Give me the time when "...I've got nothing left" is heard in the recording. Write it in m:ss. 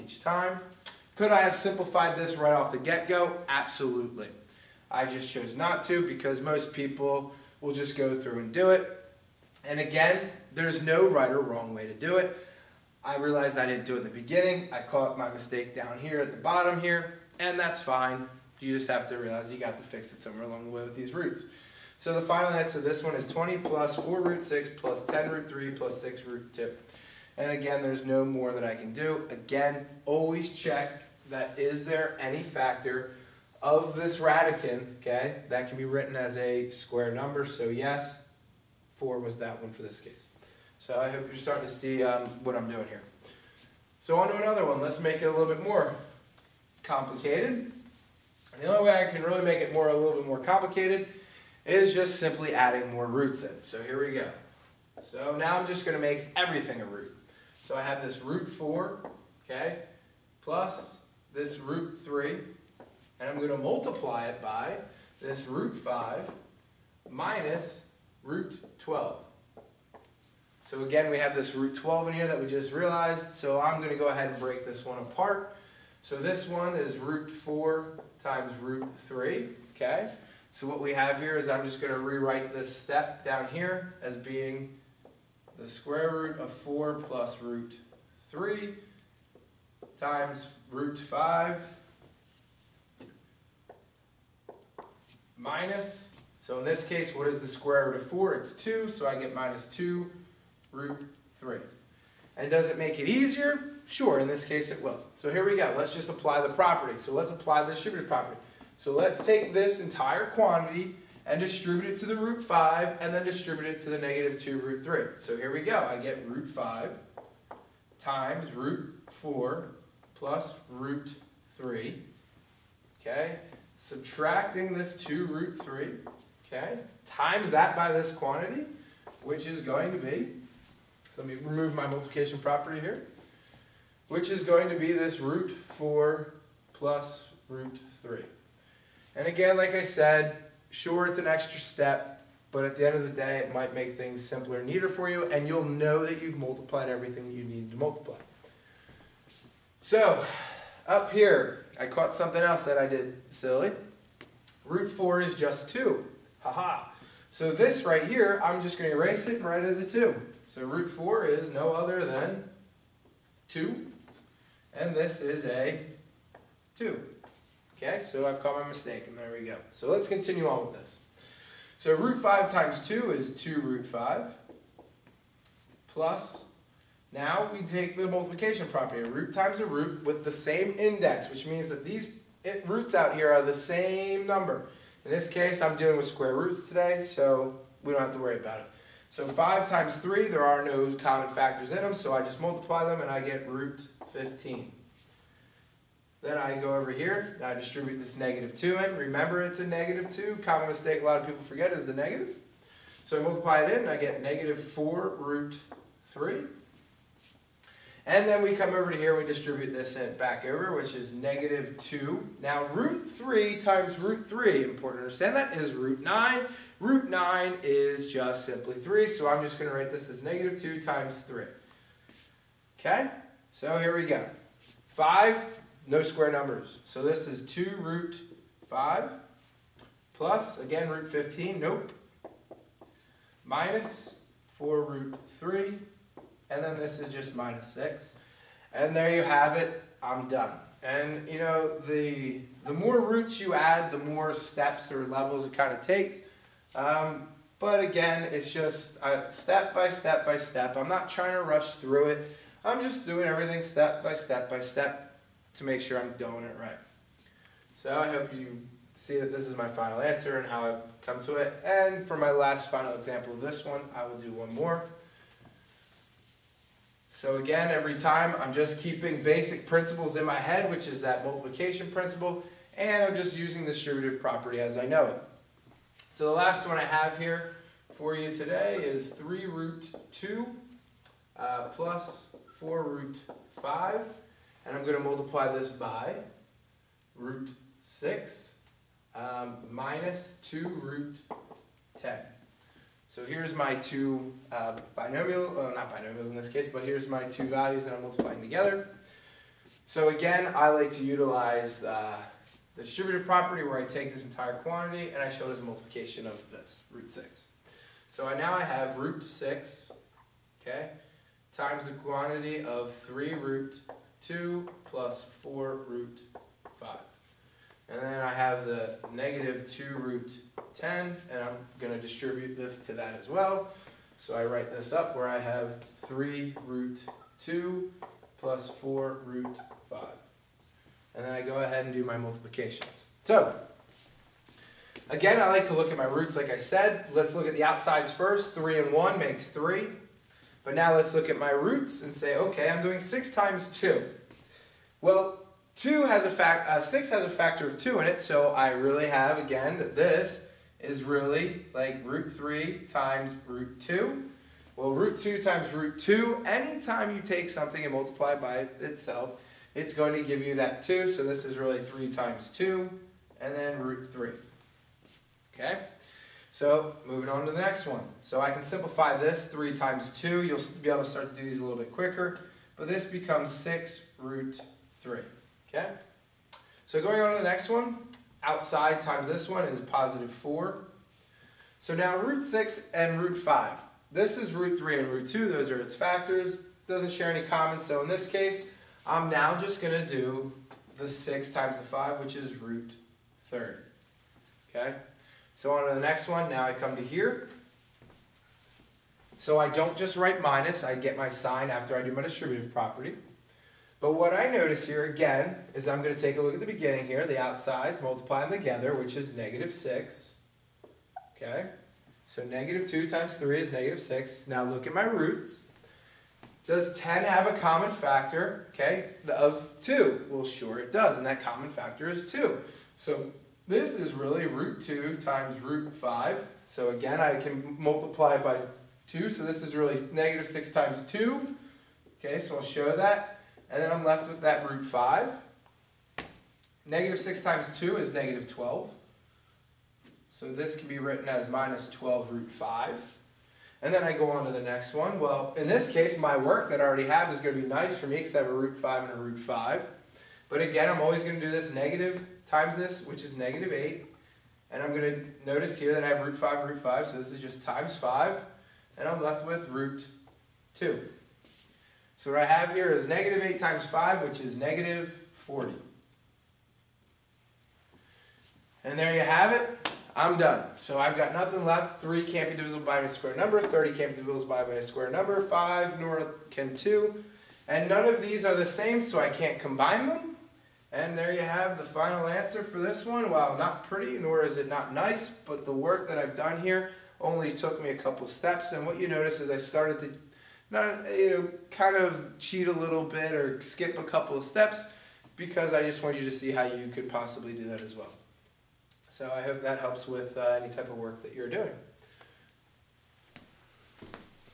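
7:50.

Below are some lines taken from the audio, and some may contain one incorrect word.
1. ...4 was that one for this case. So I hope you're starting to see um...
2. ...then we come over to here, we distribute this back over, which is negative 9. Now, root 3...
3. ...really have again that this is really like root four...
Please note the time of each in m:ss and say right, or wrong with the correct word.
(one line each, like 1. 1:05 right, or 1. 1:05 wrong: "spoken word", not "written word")
1. 0:38 right
2. 3:28 wrong: "2", not "9"
3. 5:48 wrong: "three", not "four".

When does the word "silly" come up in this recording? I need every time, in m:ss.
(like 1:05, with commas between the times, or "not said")
2:33.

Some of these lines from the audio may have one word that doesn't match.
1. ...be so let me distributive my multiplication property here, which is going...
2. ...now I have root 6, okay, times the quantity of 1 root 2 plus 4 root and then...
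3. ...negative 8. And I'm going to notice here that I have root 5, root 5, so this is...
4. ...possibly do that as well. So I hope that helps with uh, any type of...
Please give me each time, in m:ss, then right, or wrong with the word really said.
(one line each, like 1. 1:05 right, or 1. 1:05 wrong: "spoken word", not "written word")
1. 2:09 wrong: "remove", not "distributive"
2. 5:08 wrong: "3", not "1"
3. 7:33 right
4. 8:17 right.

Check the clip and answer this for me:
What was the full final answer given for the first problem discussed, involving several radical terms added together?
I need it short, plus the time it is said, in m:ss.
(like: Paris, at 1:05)
20 + 4√6 + 10√3 + 6√2, at 0:23.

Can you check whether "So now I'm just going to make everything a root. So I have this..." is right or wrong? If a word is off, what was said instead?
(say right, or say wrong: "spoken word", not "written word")
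right.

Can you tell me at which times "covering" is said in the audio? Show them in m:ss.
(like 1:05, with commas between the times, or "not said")
not said.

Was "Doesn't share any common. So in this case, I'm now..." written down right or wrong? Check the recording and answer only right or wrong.
right.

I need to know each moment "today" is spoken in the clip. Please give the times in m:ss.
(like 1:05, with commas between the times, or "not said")
3:06, 4:38.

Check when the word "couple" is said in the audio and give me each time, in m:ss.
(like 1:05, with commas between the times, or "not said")
8:07, 8:14.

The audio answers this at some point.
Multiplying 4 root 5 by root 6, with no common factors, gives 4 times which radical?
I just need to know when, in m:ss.
6:32.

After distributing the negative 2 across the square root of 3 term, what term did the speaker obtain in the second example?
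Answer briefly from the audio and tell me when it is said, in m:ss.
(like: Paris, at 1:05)
-4√3, at 3:24.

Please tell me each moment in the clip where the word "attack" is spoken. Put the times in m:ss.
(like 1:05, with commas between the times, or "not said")
not said.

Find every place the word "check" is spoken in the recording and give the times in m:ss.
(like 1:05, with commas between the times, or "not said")
0:30.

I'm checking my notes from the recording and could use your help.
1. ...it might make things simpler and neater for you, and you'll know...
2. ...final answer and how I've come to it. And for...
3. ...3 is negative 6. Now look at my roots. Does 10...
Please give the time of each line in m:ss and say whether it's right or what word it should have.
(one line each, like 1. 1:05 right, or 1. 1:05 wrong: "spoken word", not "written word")
1. 2:23 right
2. 4:19 right
3. 6:53 right.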